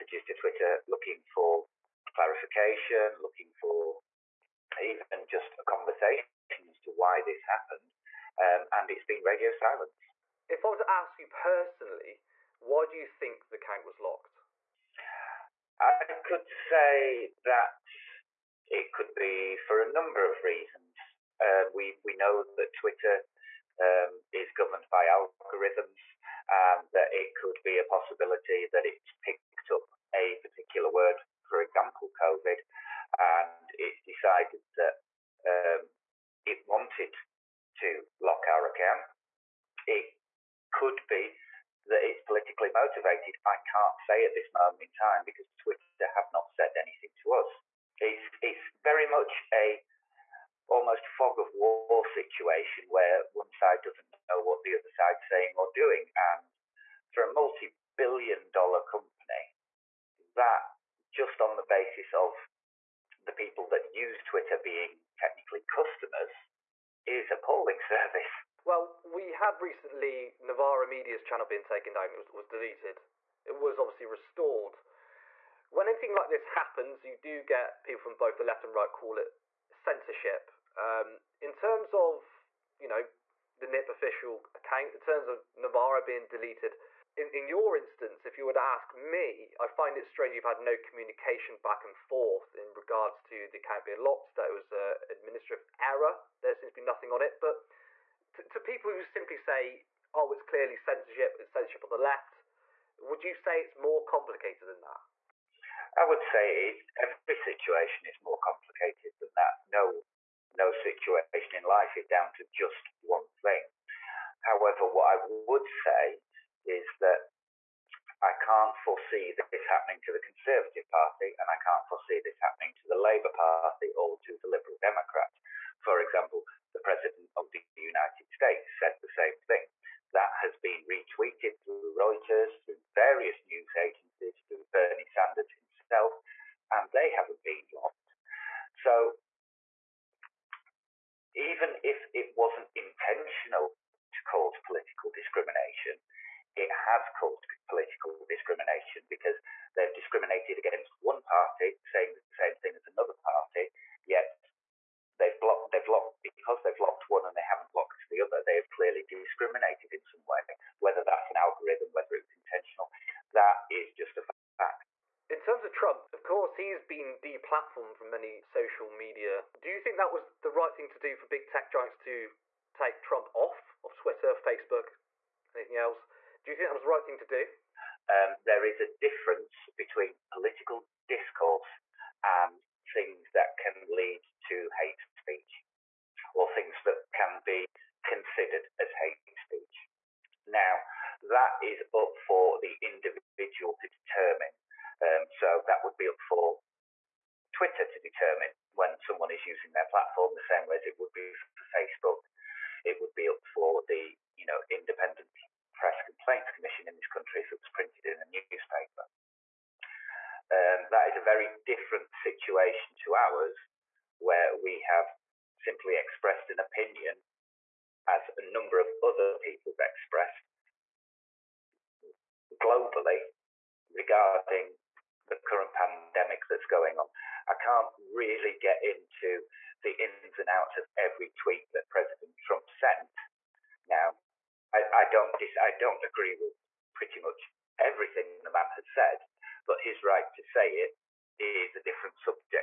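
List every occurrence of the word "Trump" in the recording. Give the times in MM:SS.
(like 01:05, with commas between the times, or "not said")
02:45, 02:53, 03:52.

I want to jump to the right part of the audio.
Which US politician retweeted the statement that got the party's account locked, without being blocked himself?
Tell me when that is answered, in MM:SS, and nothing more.
02:14.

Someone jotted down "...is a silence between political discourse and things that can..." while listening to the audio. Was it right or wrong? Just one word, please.
wrong.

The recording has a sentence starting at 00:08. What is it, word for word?
Um, and it's been radio silence.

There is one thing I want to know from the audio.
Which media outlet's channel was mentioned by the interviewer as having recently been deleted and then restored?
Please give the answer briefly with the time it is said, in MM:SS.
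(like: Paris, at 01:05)
Novara Media, at 01:10.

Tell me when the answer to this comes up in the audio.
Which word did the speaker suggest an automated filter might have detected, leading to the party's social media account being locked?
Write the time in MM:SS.
00:32.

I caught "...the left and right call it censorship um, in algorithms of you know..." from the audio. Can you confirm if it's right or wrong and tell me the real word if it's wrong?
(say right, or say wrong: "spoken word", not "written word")
wrong: "terms", not "algorithms".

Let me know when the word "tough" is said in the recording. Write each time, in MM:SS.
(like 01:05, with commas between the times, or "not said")
not said.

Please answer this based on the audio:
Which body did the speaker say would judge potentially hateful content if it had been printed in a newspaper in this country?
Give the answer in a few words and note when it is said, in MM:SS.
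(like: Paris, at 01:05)
Independent Press Complaints Commission, at 03:24.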